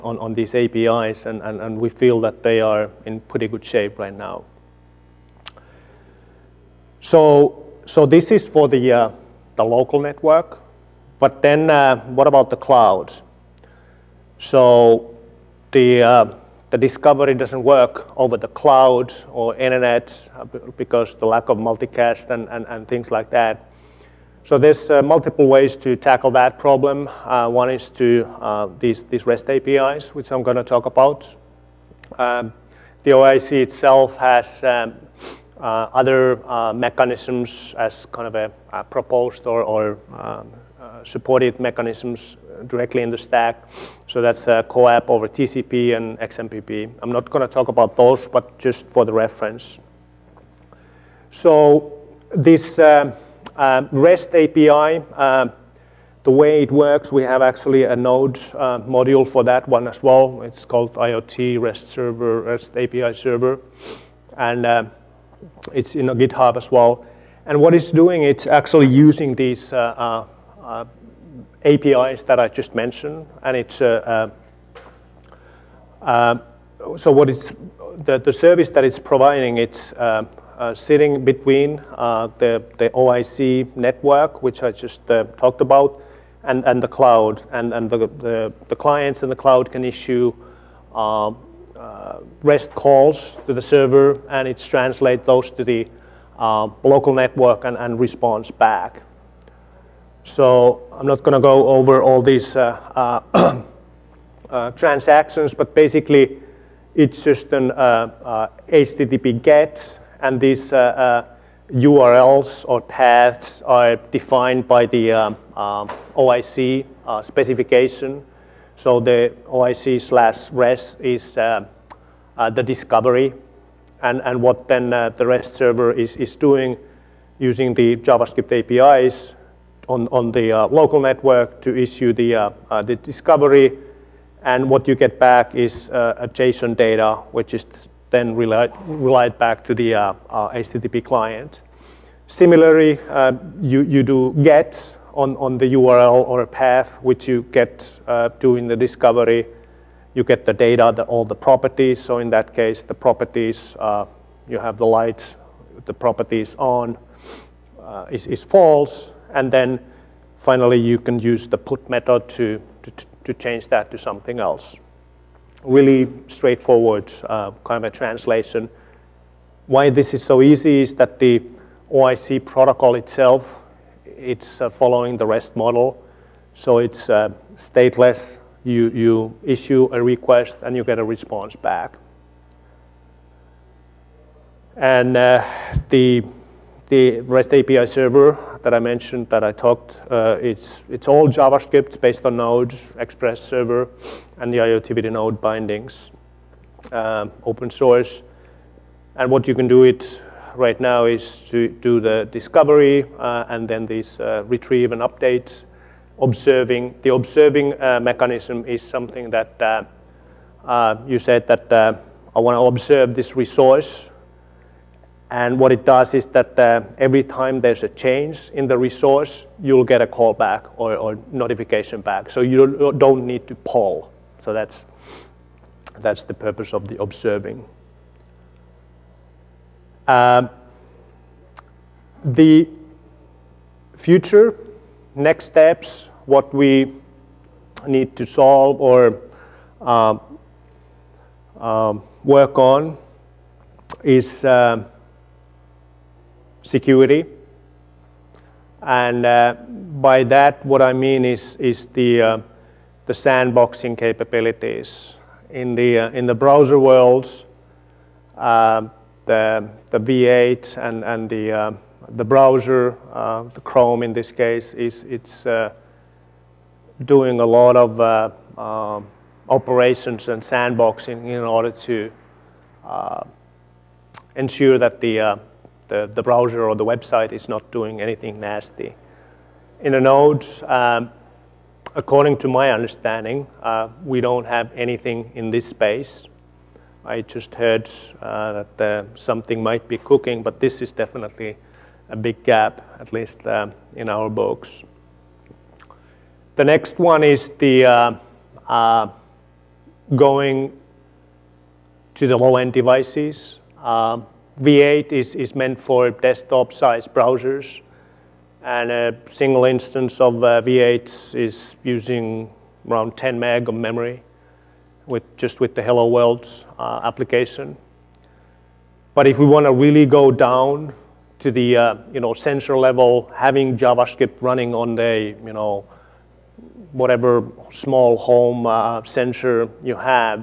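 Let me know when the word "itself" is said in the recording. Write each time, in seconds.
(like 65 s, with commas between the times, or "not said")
33 s, 172 s.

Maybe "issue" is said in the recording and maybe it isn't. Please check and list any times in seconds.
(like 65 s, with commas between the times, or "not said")
89 s, 131 s, 179 s.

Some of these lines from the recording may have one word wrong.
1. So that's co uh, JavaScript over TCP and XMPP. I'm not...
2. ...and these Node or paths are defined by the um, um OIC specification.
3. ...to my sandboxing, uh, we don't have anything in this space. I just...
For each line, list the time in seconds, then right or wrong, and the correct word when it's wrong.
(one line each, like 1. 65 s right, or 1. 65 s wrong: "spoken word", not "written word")
1. 44 s wrong: "CoAP", not "JavaScript"
2. 110 s wrong: "URLs", not "Node"
3. 282 s wrong: "understanding", not "sandboxing".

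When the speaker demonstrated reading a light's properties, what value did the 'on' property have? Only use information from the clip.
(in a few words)
false.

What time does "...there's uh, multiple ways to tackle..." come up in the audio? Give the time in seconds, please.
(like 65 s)
24 s.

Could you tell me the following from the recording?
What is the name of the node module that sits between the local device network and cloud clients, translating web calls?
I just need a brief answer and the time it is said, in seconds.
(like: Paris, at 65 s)
IoT REST Server, at 60 s.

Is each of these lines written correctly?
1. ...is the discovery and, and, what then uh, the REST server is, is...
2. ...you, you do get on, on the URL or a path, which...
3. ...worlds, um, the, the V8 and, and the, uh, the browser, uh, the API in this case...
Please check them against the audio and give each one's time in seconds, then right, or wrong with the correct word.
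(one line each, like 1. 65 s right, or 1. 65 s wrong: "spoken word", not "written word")
1. 121 s right
2. 143 s right
3. 256 s wrong: "Chrome", not "API".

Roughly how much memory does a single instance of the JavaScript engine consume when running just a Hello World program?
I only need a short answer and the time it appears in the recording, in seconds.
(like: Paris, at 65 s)
10 meg, at 313 s.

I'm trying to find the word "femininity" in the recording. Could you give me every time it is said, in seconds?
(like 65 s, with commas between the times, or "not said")
not said.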